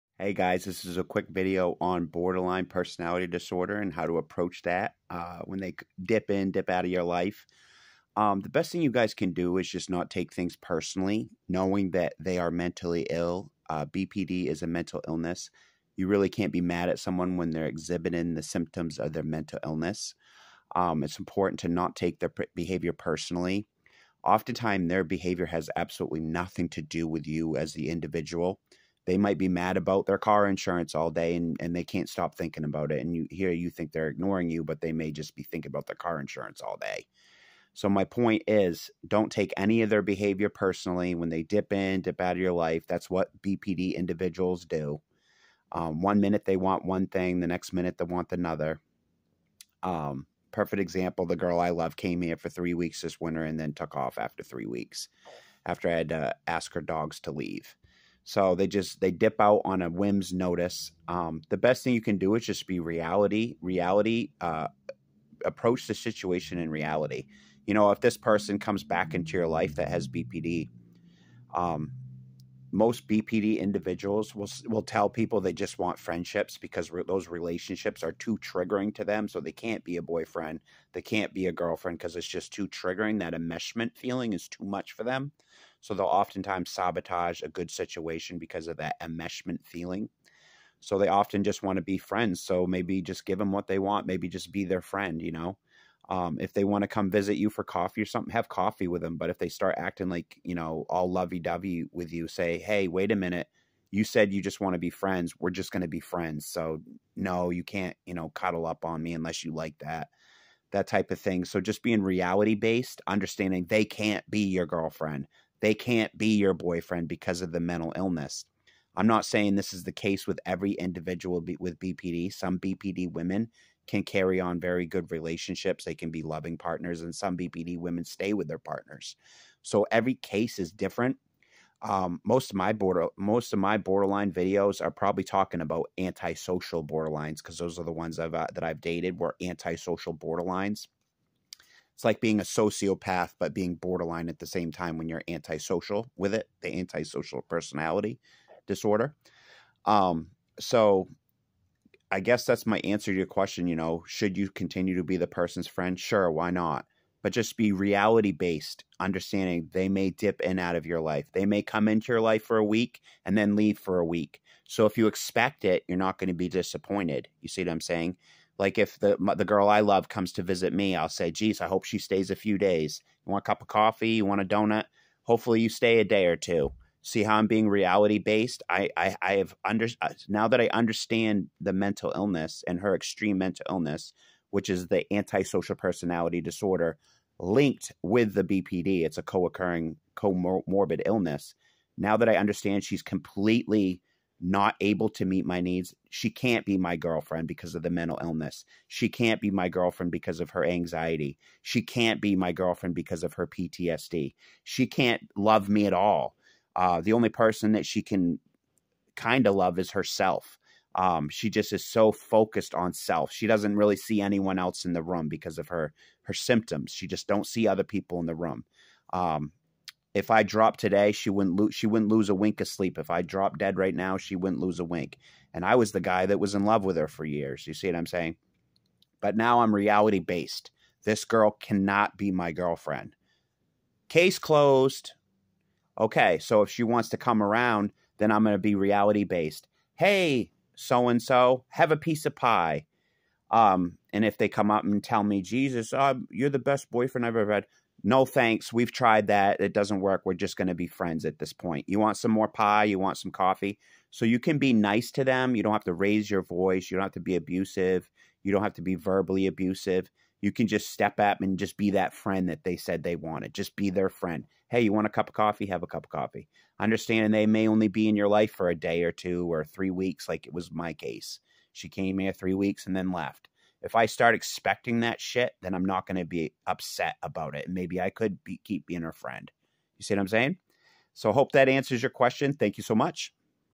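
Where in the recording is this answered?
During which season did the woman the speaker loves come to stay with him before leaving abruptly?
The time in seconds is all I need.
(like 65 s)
53 s.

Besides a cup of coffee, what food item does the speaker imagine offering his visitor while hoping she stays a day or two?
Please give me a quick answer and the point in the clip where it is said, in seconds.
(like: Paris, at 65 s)
a donut, at 174 s.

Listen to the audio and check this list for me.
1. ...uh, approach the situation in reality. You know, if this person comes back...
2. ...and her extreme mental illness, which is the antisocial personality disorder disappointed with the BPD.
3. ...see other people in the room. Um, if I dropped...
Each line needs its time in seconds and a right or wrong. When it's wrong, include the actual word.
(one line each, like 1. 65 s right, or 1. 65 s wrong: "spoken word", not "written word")
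1. 64 s right
2. 182 s wrong: "linked", not "disappointed"
3. 217 s right.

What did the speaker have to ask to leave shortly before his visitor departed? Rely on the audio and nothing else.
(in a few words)
her dogs.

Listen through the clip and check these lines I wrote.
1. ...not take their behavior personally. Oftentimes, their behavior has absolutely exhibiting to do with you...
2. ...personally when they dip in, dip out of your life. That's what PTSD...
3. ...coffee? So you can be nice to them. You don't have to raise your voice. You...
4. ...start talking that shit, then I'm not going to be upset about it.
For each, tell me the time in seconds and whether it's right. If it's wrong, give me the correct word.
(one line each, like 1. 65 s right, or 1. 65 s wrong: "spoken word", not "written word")
1. 21 s wrong: "nothing", not "exhibiting"
2. 40 s wrong: "BPD", not "PTSD"
3. 253 s right
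4. 274 s wrong: "expecting", not "talking".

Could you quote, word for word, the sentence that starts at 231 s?
This girl cannot be my girlfriend.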